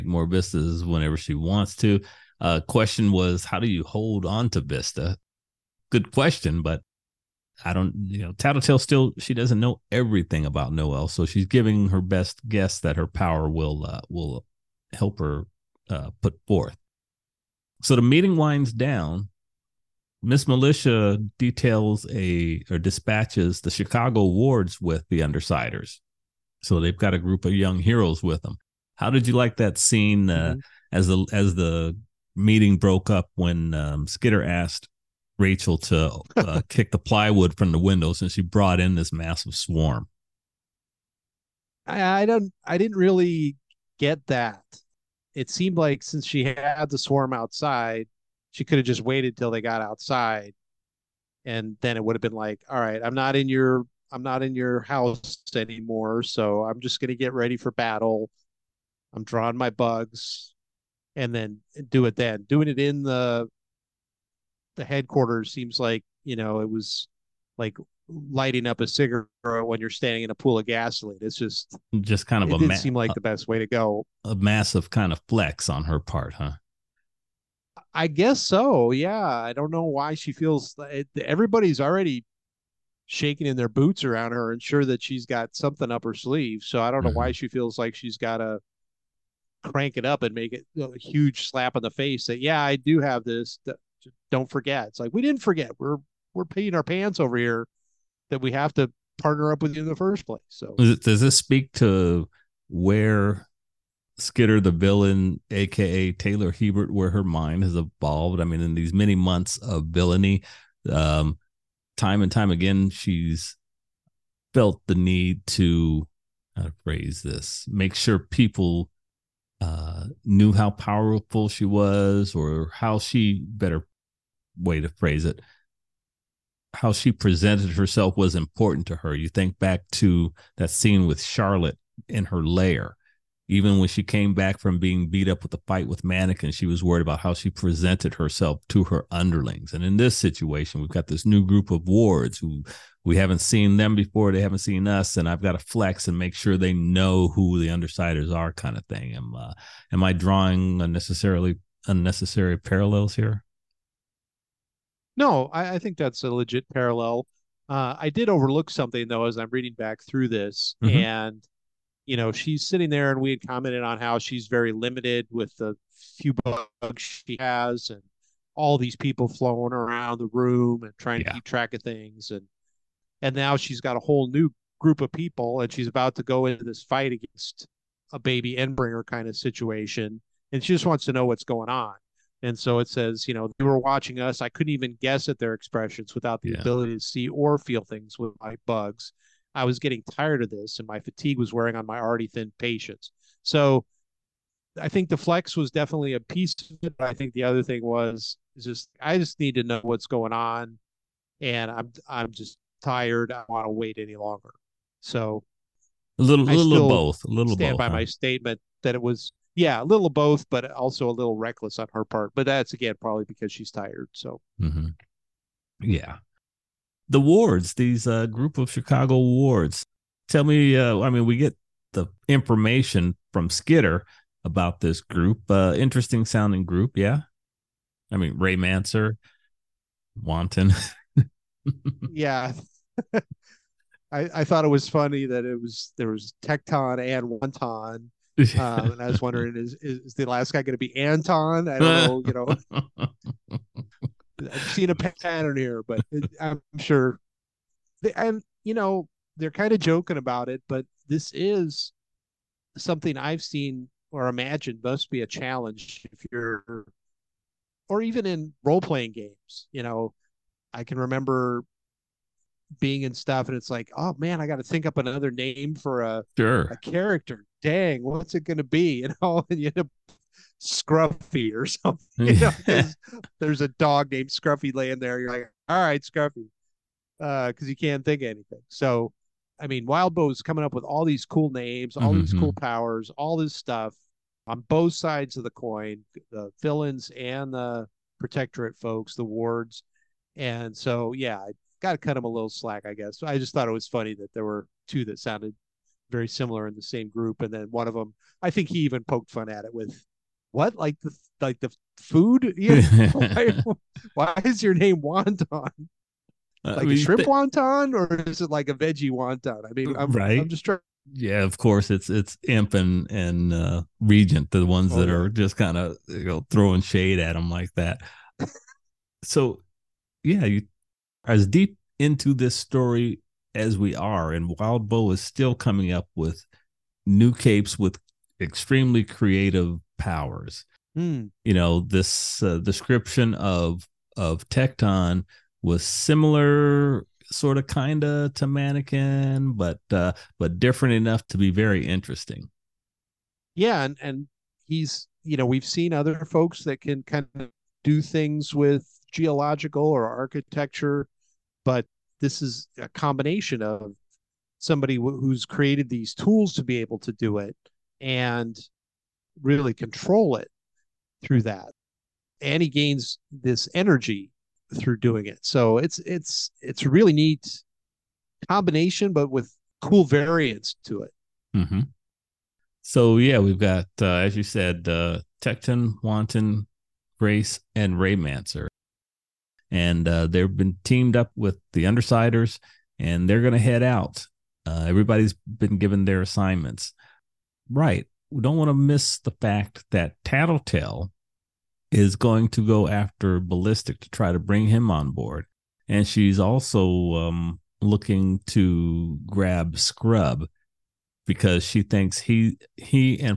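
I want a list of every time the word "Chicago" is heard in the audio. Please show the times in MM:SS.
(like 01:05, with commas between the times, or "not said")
00:23, 03:38.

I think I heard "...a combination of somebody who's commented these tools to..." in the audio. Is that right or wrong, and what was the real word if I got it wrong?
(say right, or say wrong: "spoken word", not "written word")
wrong: "created", not "commented".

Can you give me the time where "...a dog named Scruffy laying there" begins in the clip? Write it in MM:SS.
04:33.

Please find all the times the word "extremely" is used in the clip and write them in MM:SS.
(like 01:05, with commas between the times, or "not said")
05:28.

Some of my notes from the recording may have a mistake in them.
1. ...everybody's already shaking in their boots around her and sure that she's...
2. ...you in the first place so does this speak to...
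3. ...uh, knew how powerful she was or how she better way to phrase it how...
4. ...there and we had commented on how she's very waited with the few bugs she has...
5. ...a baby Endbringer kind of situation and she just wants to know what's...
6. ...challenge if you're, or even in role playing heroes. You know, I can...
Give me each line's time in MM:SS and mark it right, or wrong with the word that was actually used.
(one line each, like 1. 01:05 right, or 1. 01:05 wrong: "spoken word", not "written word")
1. 01:21 right
2. 01:39 right
3. 01:59 right
4. 02:42 wrong: "limited", not "waited"
5. 02:58 right
6. 04:15 wrong: "games", not "heroes".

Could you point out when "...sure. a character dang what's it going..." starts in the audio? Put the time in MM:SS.
04:26.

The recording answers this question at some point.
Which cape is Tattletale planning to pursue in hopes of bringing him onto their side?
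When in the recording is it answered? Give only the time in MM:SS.
06:33.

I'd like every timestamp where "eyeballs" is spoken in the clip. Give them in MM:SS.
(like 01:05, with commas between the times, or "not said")
not said.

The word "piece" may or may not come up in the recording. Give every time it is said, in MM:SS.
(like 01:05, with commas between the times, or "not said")
03:16.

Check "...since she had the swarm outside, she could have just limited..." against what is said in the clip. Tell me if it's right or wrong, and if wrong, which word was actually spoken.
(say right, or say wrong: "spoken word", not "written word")
wrong: "waited", not "limited".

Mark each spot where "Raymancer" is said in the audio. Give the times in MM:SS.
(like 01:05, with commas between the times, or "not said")
03:48, 06:17.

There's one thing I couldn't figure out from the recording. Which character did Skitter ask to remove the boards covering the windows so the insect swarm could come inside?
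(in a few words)
Rachel.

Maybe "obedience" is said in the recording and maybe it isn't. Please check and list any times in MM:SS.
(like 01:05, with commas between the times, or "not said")
not said.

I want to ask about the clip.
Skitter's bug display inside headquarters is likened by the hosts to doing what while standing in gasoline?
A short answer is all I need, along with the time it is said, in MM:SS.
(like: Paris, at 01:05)
lighting up a cigarette, at 01:08.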